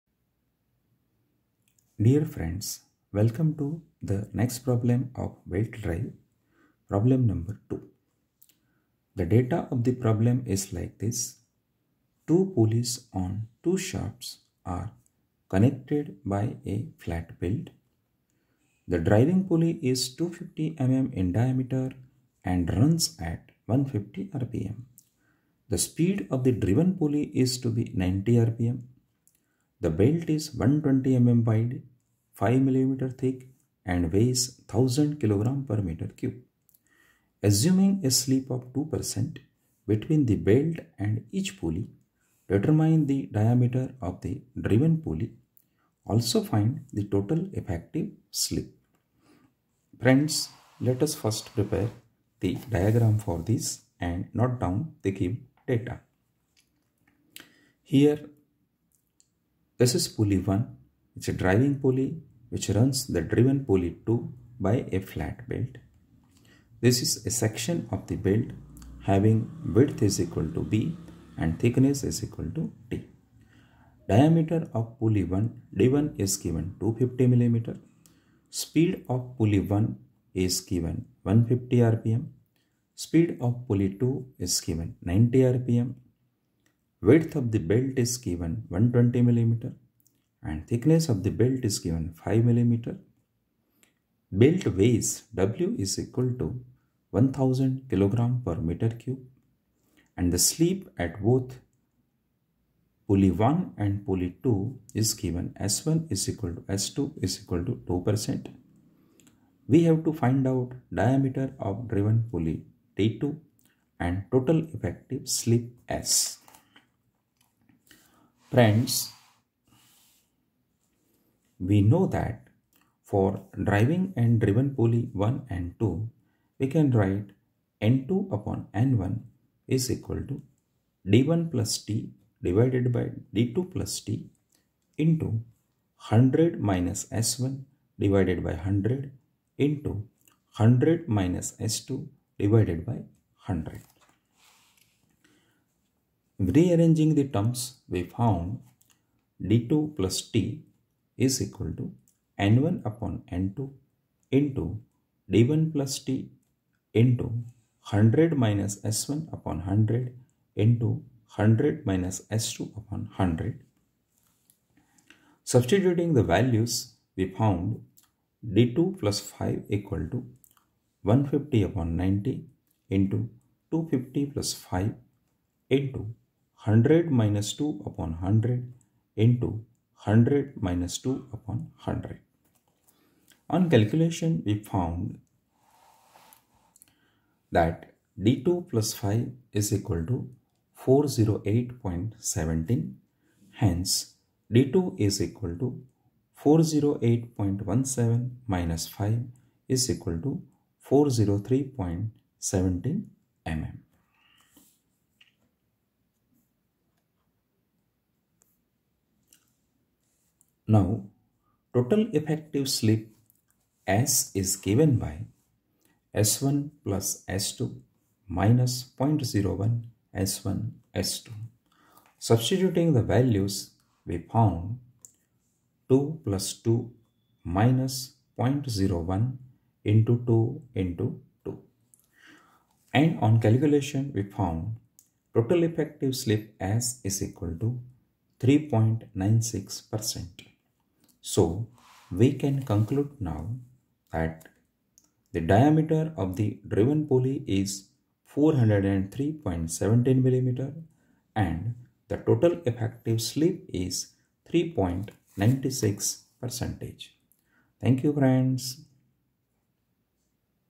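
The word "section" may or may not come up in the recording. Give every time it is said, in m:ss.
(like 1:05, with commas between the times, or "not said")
1:07.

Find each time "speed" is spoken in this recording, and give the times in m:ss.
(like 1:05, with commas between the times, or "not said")
0:25, 1:18, 1:22.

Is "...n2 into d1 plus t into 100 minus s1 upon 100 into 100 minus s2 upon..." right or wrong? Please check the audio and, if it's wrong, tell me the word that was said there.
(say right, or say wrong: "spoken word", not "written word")
right.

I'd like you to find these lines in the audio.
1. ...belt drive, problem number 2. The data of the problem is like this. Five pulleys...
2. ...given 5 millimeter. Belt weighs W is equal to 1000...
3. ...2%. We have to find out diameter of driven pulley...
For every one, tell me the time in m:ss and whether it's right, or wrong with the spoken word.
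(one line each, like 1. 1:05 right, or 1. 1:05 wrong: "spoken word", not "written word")
1. 0:05 wrong: "Two", not "Five"
2. 1:31 right
3. 1:47 right.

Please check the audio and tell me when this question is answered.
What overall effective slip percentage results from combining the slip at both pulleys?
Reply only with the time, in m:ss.
3:58.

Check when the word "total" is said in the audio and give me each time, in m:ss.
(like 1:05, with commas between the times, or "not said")
0:47, 1:54, 3:31, 3:55, 4:12.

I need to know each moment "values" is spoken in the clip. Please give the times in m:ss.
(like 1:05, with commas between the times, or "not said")
2:46, 3:43.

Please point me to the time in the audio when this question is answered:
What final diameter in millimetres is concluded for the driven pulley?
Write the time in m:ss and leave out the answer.
4:08.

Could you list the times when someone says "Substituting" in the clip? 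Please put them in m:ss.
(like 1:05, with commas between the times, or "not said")
2:45, 3:42.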